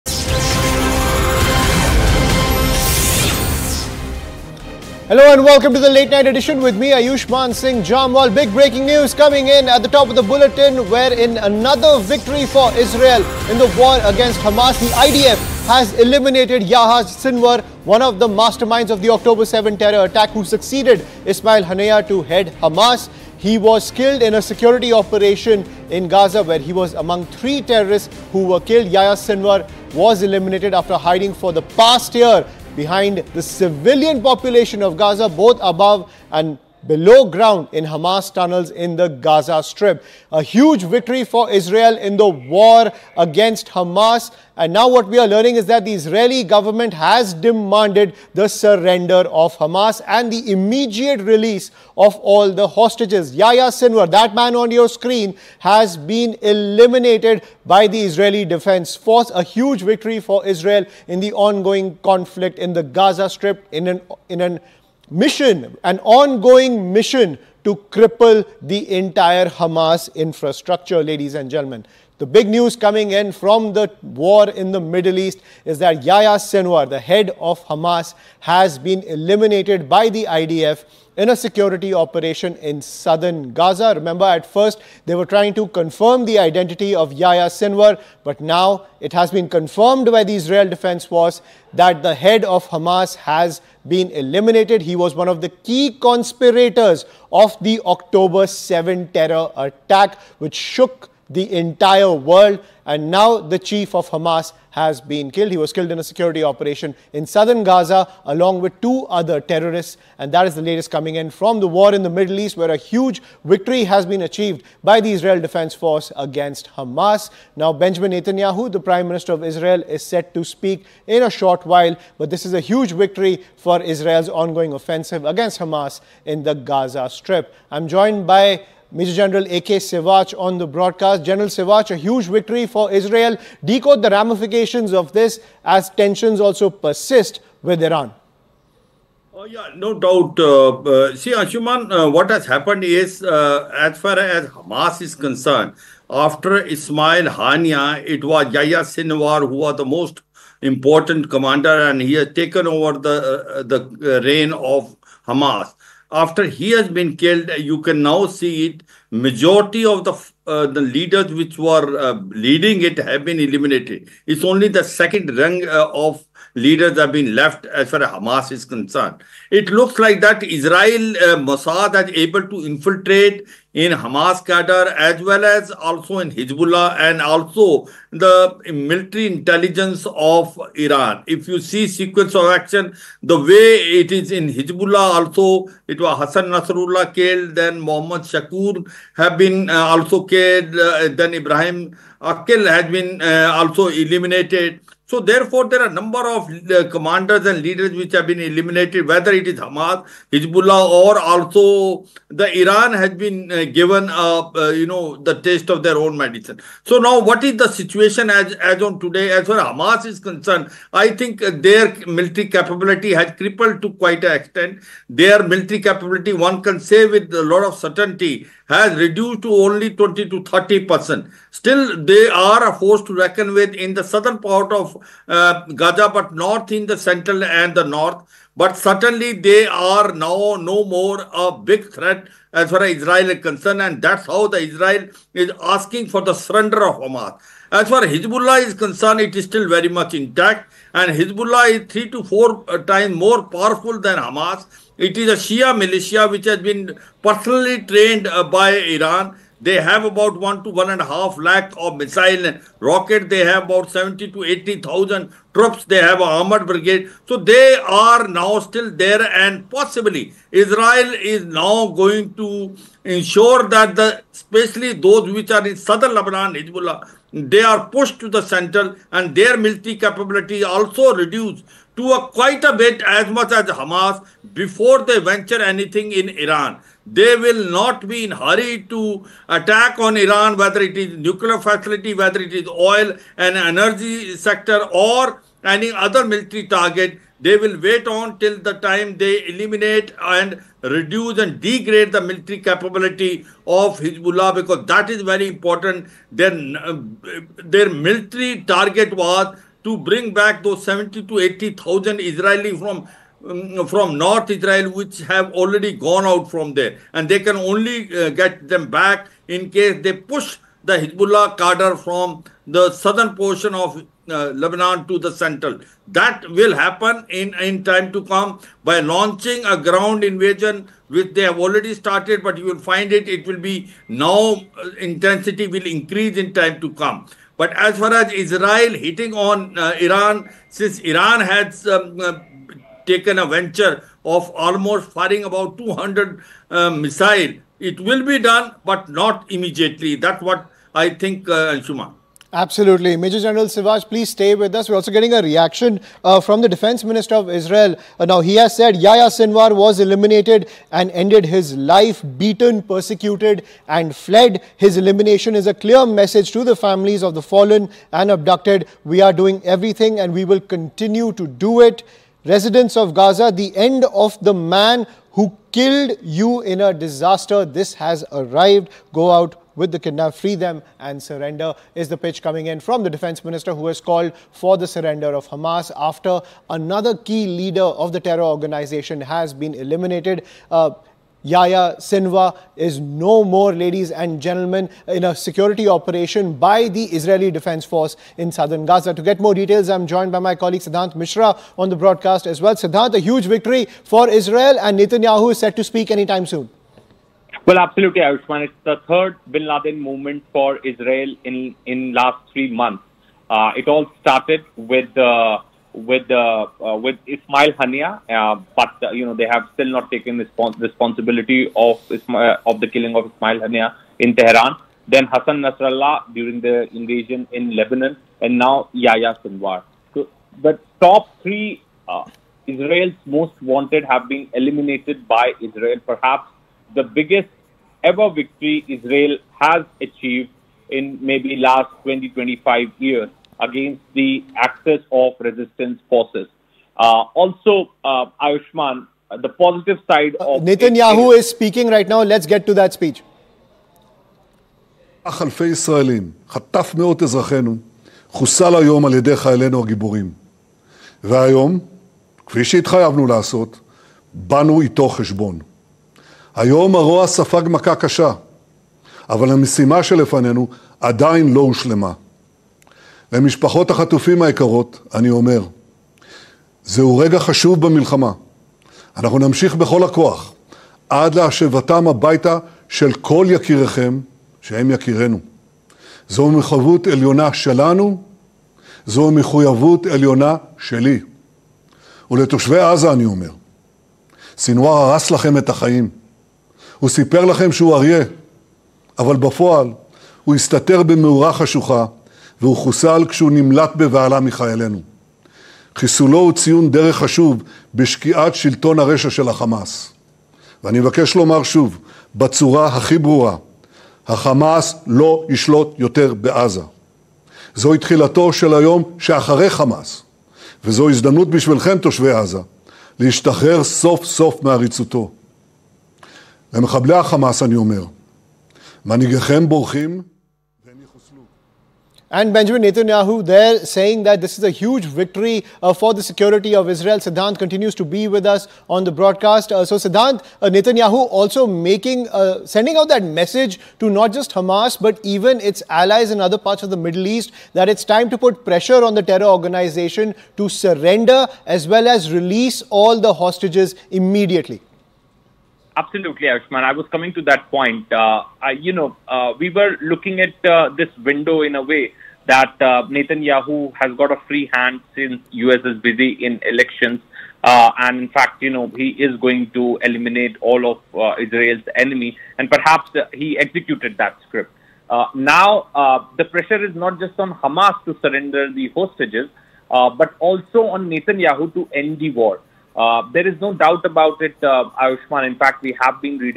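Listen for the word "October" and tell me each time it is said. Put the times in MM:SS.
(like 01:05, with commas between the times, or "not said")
00:19, 01:37.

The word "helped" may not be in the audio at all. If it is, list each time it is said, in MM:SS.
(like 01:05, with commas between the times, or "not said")
not said.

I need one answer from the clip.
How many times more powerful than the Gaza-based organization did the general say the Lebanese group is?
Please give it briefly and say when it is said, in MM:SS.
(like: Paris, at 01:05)
three to four, at 04:01.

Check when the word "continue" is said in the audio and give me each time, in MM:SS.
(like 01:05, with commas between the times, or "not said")
06:00, 08:47.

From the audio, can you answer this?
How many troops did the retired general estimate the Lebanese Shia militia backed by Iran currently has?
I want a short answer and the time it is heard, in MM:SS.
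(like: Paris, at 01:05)
70 to 80,000, at 04:13.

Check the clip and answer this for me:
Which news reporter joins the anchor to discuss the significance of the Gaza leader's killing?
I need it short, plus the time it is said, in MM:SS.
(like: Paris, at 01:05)
Siddhant Mishra, at 06:30.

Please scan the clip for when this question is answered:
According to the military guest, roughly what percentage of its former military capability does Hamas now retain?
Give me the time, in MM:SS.
03:39.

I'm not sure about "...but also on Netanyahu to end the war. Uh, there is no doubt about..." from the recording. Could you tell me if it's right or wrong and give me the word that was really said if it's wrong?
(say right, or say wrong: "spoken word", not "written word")
right.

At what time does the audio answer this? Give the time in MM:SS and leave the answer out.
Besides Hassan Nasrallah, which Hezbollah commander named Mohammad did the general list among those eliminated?
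03:07.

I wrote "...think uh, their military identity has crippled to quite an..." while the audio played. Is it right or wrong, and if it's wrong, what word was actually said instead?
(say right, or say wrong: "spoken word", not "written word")
wrong: "capability", not "identity".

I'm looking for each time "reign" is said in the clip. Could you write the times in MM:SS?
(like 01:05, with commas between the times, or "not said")
02:34.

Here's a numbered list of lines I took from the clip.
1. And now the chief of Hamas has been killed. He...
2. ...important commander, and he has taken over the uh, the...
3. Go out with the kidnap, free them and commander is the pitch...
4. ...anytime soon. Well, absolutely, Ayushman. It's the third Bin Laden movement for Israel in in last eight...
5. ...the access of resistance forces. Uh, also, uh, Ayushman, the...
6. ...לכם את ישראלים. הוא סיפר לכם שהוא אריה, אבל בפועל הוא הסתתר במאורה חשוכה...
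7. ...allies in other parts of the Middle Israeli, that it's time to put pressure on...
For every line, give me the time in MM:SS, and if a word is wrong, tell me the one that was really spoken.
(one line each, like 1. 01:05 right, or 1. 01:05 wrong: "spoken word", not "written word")
1. 01:42 right
2. 02:30 right
3. 06:09 wrong: "surrender", not "commander"
4. 06:36 wrong: "three", not "eight"
5. 07:14 right
6. 08:05 wrong: "החיים", not "ישראלים"
7. 08:55 wrong: "East", not "Israeli".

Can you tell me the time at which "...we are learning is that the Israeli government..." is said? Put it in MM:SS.
00:45.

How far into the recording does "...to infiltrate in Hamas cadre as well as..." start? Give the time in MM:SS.
02:52.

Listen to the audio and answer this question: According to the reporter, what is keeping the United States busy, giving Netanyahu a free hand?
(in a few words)
elections.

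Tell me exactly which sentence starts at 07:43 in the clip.
למשפחות החטופים היקרות, אני אומר, זהו רגע חשוב במלחמה.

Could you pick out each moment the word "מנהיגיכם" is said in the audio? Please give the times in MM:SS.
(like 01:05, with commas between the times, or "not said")
08:39.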